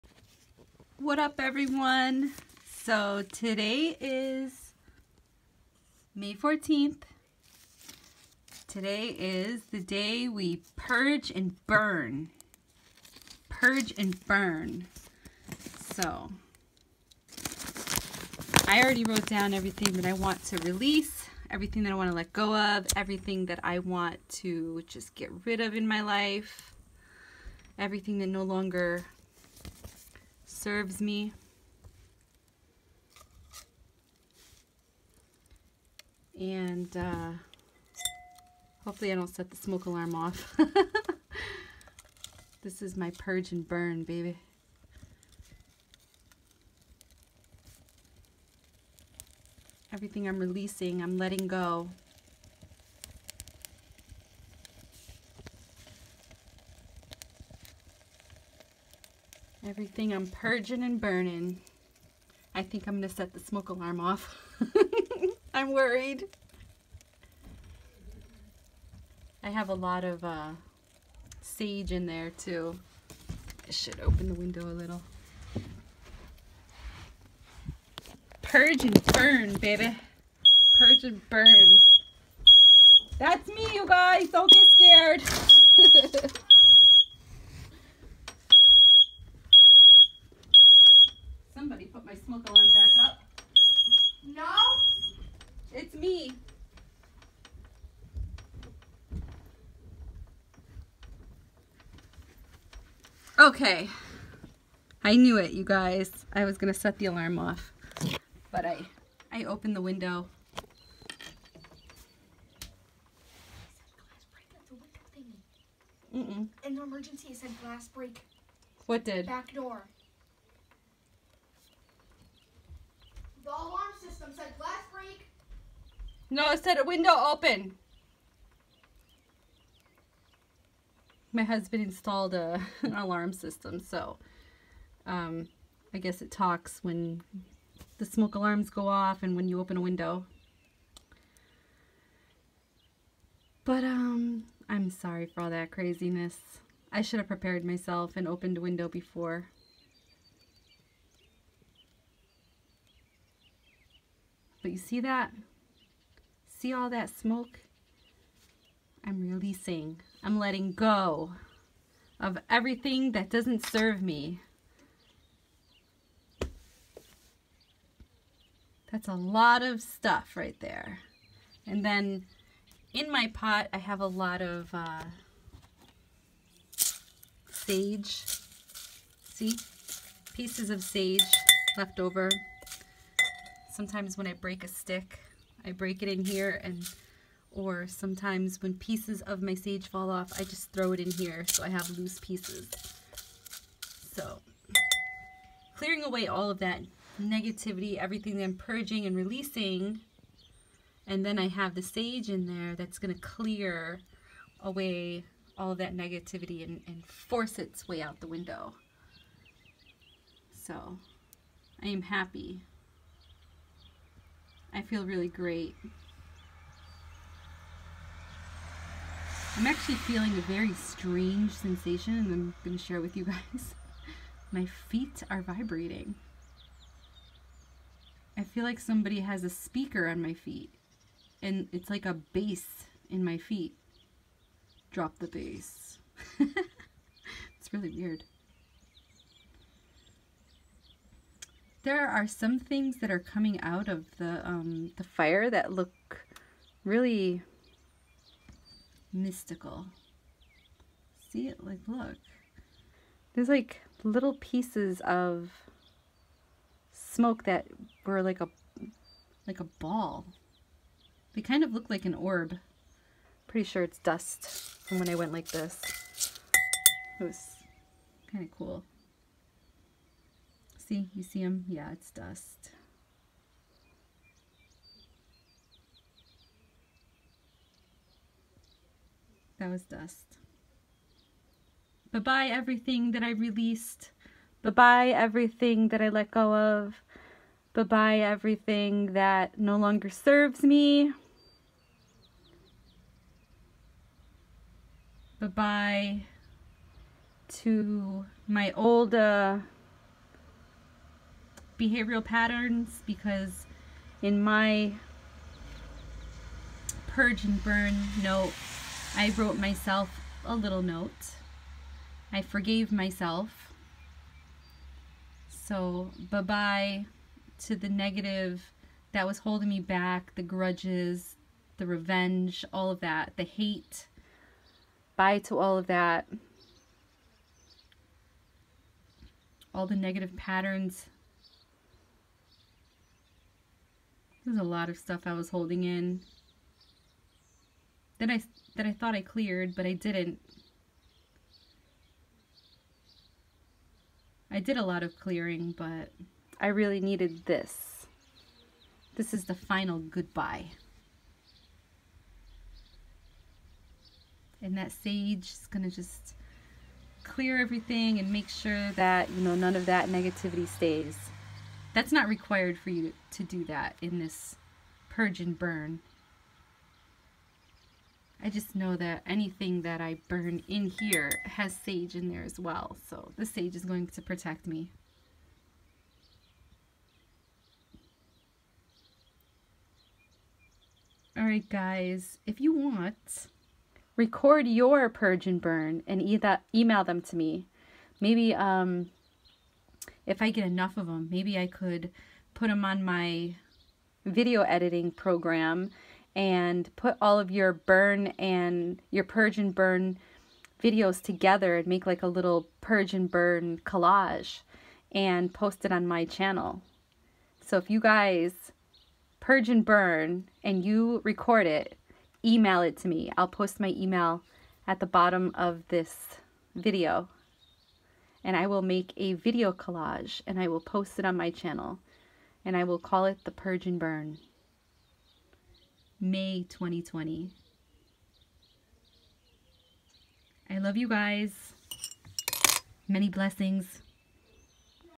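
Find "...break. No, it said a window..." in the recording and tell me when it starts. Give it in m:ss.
2:04.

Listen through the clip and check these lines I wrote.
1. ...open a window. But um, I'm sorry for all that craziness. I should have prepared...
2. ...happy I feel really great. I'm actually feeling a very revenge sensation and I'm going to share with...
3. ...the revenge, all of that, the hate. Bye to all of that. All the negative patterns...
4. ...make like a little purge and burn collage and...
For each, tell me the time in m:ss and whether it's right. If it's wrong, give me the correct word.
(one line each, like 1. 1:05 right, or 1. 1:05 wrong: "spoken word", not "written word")
1. 2:19 right
2. 3:32 wrong: "strange", not "revenge"
3. 5:21 right
4. 6:41 right.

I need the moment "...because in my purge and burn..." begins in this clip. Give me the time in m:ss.
5:03.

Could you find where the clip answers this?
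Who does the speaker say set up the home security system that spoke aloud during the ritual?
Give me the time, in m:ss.
2:11.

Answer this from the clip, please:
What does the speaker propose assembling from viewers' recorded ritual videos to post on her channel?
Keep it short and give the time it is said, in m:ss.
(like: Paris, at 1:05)
a video collage, at 6:59.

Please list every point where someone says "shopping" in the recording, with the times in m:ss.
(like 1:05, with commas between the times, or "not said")
not said.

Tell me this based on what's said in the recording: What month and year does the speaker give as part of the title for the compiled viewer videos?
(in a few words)
May 2020.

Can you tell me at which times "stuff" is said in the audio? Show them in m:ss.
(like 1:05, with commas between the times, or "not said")
2:49, 5:34.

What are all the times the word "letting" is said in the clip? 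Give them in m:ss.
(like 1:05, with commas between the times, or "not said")
0:51, 2:40.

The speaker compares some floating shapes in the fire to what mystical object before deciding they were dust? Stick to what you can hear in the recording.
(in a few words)
an orb.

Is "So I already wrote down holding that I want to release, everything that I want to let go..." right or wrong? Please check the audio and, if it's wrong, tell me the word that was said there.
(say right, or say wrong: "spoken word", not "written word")
wrong: "everything", not "holding".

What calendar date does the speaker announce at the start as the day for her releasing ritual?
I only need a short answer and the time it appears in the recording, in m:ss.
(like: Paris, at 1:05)
May 14th, at 0:06.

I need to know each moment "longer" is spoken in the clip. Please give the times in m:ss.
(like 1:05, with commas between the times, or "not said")
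0:28, 4:49.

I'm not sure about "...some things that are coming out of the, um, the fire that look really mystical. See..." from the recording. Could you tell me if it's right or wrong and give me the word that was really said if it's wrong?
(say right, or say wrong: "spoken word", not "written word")
right.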